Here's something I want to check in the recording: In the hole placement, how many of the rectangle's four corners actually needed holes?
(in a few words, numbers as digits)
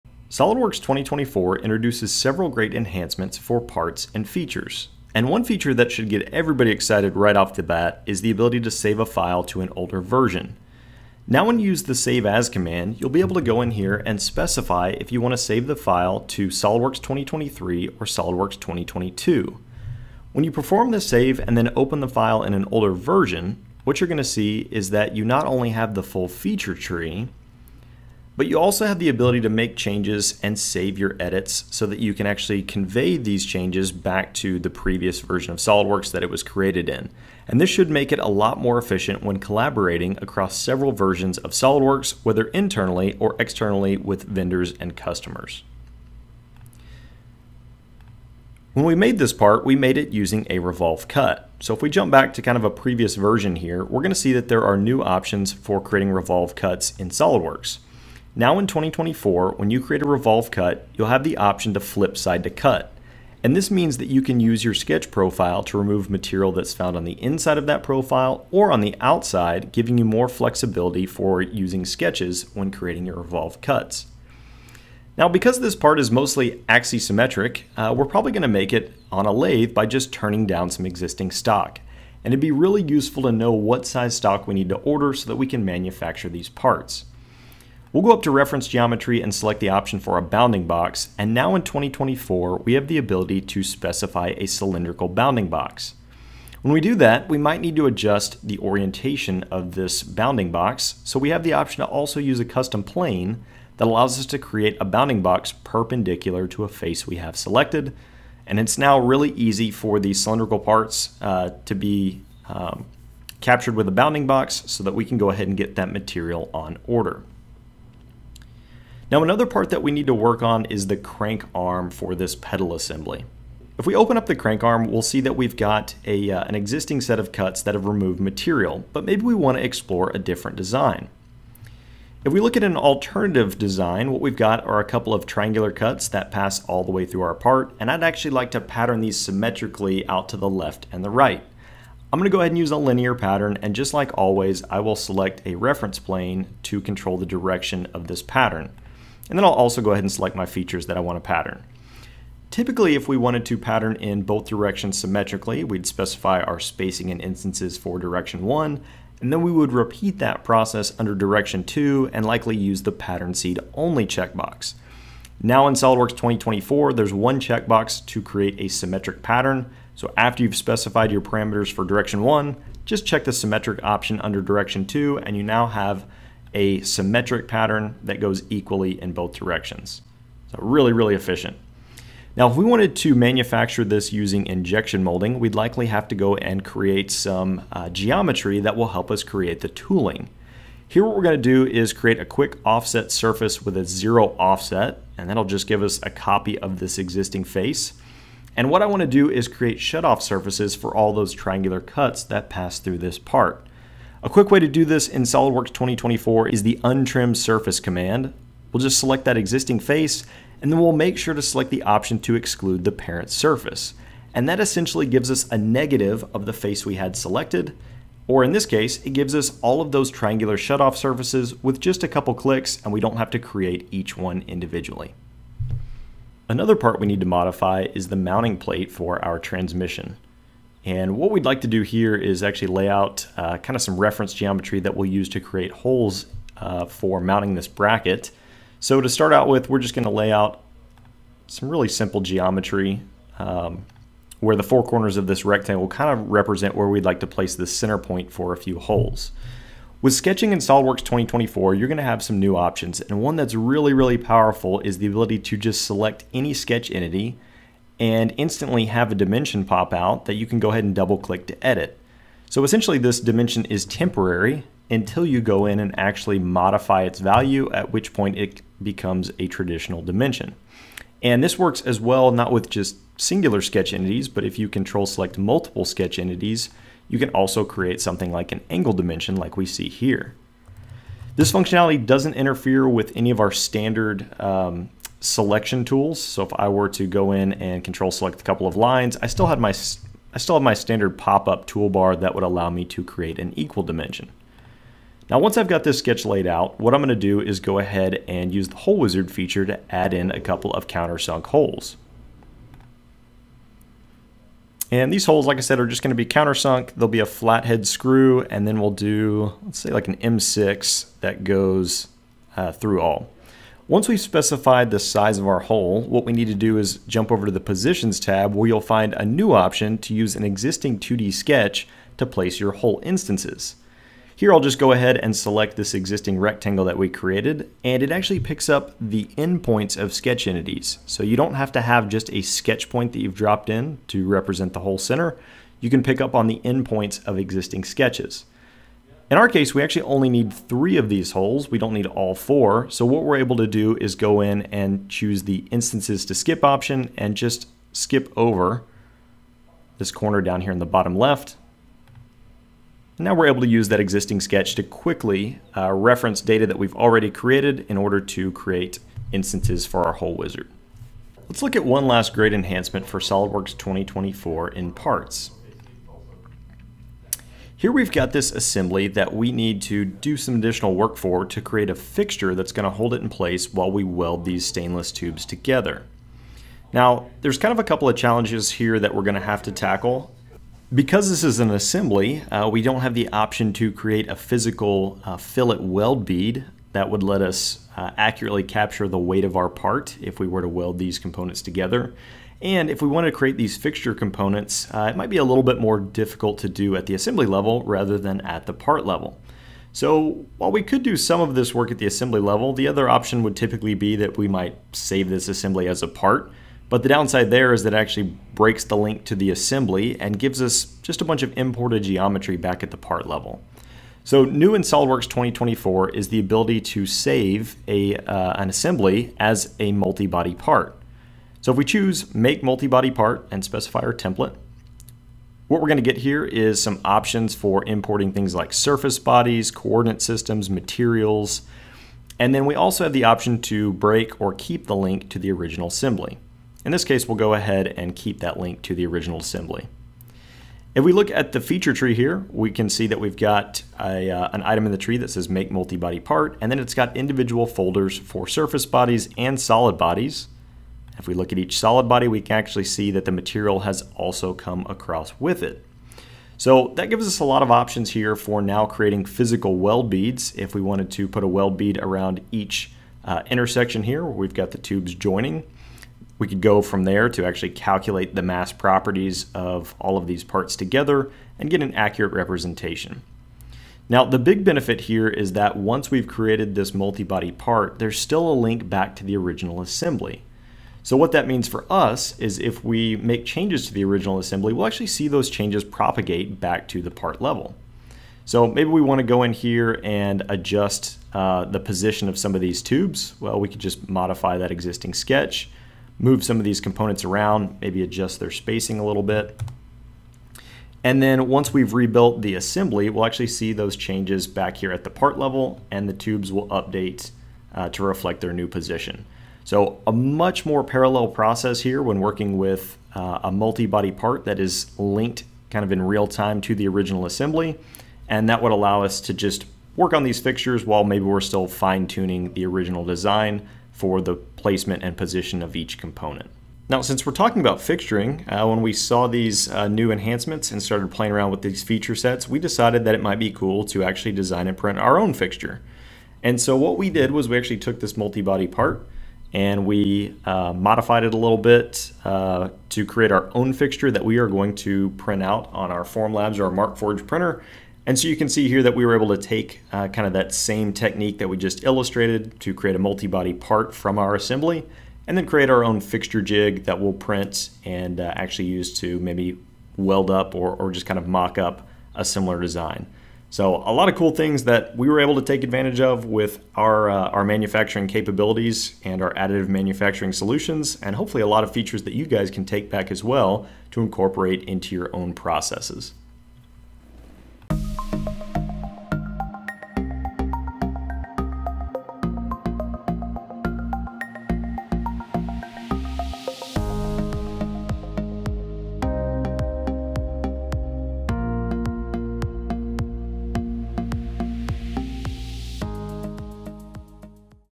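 3.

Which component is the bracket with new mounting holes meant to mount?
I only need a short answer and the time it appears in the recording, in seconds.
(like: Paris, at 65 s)
Transmission, at 229 s.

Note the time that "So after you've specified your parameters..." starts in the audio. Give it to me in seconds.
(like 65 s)
169 s.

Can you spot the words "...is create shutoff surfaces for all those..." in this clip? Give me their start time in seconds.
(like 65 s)
199 s.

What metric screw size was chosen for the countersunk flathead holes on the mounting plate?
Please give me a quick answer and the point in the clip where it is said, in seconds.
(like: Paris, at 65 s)
M6, at 310 s.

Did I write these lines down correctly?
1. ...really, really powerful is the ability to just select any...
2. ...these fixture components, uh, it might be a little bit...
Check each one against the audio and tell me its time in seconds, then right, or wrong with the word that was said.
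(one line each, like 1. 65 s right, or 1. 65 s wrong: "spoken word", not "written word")
1. 253 s right
2. 393 s right.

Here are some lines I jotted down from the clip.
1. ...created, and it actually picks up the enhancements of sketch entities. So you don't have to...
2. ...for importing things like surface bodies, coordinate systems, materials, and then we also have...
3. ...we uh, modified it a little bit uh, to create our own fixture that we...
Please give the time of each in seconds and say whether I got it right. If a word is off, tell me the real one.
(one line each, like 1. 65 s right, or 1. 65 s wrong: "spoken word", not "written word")
1. 327 s wrong: "endpoints", not "enhancements"
2. 427 s right
3. 539 s right.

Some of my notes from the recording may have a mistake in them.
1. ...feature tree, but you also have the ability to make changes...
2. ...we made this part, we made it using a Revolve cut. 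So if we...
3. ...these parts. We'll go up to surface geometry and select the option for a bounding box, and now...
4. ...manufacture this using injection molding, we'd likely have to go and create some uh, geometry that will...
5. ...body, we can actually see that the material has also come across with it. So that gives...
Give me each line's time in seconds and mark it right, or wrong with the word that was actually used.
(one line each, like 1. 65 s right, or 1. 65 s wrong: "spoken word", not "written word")
1. 26 s right
2. 48 s right
3. 86 s wrong: "reference", not "surface"
4. 183 s right
5. 452 s right.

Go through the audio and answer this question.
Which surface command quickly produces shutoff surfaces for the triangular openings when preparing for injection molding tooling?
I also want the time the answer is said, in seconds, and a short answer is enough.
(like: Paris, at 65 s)
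Untrim surface, at 206 s.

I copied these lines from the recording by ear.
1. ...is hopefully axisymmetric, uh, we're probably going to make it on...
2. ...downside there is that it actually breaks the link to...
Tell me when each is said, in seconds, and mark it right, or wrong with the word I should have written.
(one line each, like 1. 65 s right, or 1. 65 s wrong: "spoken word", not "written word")
1. 75 s wrong: "mostly", not "hopefully"
2. 407 s right.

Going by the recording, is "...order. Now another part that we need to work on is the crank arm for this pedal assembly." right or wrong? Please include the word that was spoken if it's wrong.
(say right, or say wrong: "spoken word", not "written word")
right.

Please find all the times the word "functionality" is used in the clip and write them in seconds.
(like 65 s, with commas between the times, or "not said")
281 s.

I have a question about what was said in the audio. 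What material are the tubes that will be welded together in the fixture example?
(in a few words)
Stainless.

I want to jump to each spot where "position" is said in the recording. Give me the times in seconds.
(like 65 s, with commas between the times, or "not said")
317 s, 491 s, 508 s, 525 s.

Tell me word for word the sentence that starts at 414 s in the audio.
So new in SOLIDWORKS 2024 is the ability to save a, uh, an assembly as a multi-body part.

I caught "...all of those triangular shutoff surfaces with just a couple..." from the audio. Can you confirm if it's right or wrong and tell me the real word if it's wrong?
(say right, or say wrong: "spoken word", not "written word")
right.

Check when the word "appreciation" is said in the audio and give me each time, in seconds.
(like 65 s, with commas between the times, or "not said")
not said.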